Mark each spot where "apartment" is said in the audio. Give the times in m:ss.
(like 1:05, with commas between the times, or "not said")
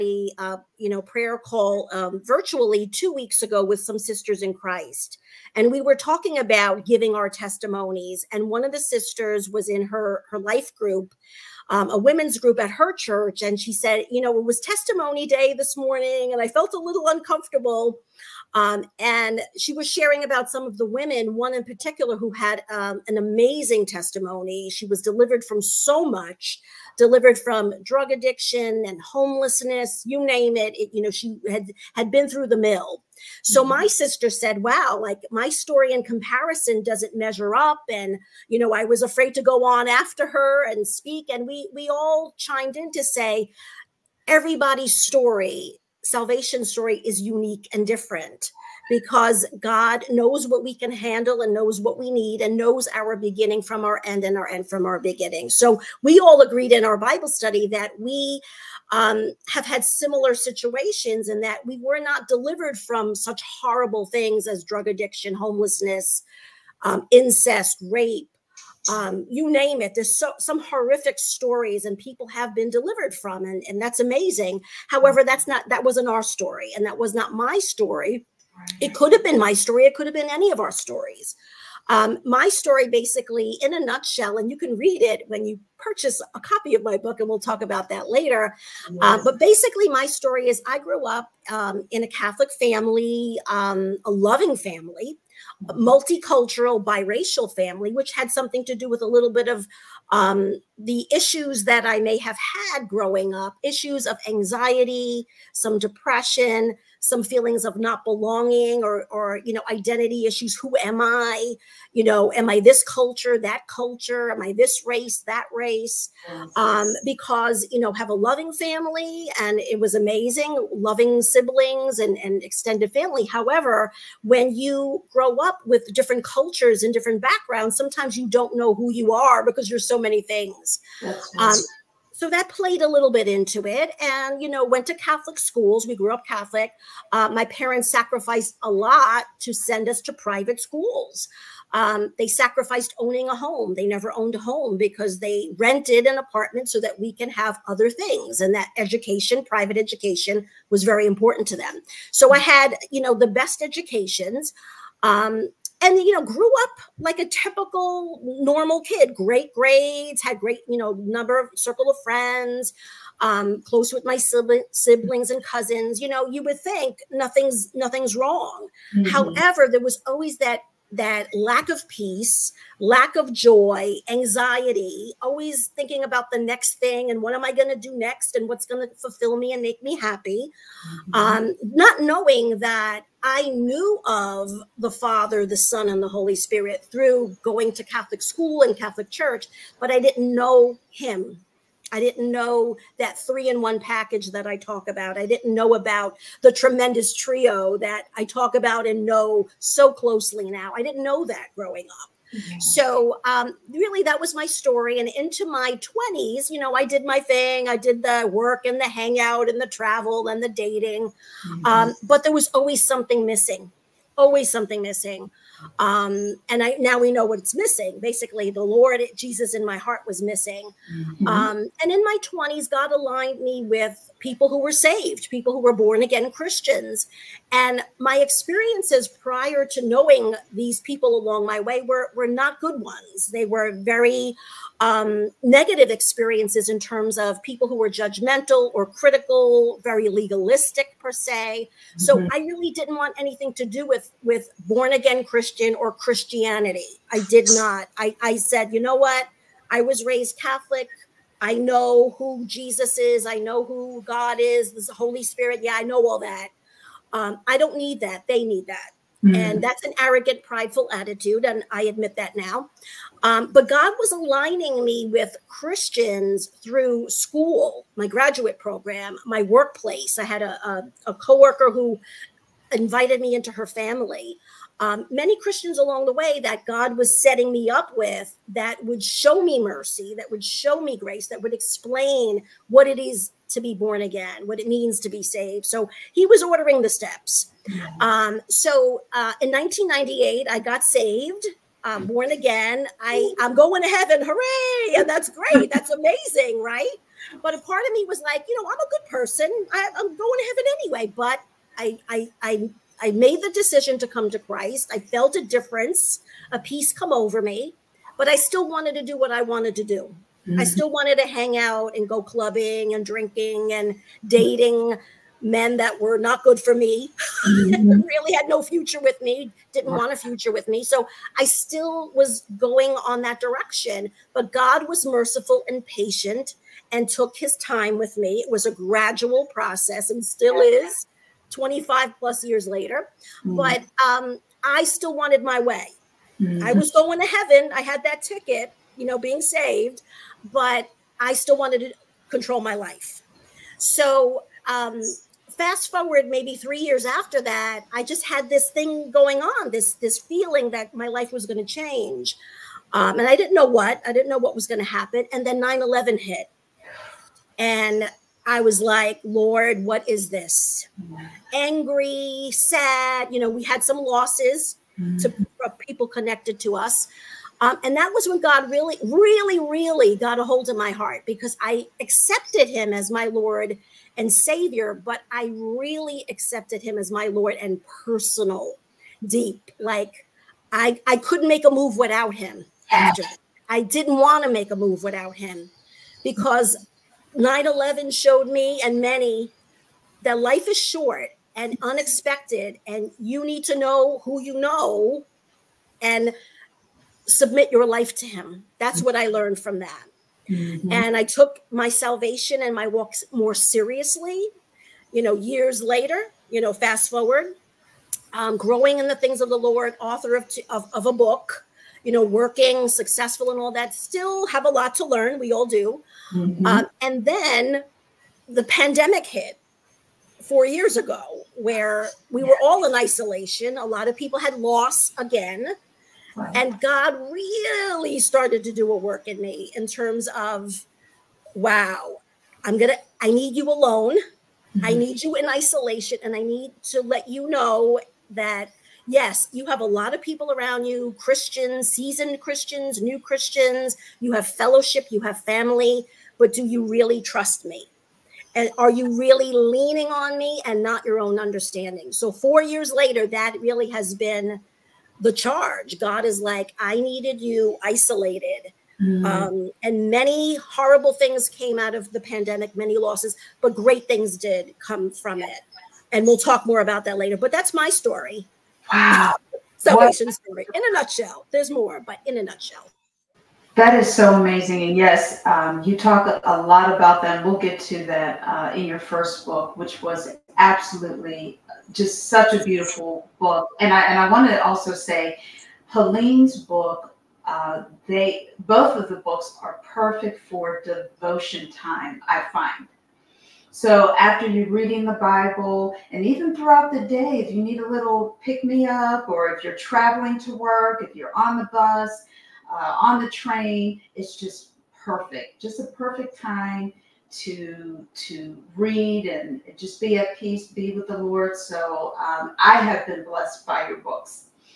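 2:26.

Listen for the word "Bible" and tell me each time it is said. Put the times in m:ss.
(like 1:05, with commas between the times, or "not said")
0:56, 8:15.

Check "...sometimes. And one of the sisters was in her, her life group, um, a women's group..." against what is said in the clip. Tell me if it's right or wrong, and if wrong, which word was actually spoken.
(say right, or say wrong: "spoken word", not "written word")
wrong: "testimonies", not "sometimes".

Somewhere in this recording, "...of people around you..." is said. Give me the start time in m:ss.
7:20.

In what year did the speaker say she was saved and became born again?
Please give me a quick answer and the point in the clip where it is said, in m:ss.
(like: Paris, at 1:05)
1998, at 4:49.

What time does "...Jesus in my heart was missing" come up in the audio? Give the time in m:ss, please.
3:39.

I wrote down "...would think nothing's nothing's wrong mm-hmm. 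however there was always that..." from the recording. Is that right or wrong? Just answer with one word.
right.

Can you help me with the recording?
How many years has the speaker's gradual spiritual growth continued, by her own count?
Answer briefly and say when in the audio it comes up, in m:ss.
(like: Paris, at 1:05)
25 plus years, at 5:31.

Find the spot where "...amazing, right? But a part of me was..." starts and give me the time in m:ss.
4:55.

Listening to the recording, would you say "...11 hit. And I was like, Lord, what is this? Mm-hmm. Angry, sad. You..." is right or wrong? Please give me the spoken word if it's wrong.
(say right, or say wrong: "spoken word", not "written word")
right.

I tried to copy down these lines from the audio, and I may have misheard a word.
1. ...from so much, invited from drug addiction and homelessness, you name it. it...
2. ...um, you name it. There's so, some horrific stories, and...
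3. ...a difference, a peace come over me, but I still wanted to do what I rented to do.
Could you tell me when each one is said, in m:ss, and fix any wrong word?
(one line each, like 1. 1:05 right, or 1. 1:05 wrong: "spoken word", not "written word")
1. 0:25 wrong: "delivered", not "invited"
2. 1:08 right
3. 5:05 wrong: "wanted", not "rented".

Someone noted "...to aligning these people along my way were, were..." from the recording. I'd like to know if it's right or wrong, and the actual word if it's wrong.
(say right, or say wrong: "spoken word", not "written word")
wrong: "knowing", not "aligning".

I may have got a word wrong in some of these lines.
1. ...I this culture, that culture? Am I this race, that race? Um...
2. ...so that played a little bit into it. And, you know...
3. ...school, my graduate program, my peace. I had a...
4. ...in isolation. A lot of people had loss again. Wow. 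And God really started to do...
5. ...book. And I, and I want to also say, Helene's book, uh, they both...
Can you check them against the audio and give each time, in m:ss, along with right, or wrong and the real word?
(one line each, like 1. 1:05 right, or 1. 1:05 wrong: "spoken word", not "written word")
1. 1:52 right
2. 2:12 right
3. 4:27 wrong: "workplace", not "peace"
4. 7:02 right
5. 8:03 right.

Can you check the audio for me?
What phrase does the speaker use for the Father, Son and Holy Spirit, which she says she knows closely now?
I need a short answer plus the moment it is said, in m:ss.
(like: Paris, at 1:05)
Tremendous trio, at 3:16.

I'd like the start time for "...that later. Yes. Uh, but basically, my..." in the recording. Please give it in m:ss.
1:27.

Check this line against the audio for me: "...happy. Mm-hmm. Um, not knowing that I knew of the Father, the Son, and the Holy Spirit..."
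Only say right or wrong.
right.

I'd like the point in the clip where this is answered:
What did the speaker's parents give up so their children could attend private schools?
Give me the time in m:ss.
2:22.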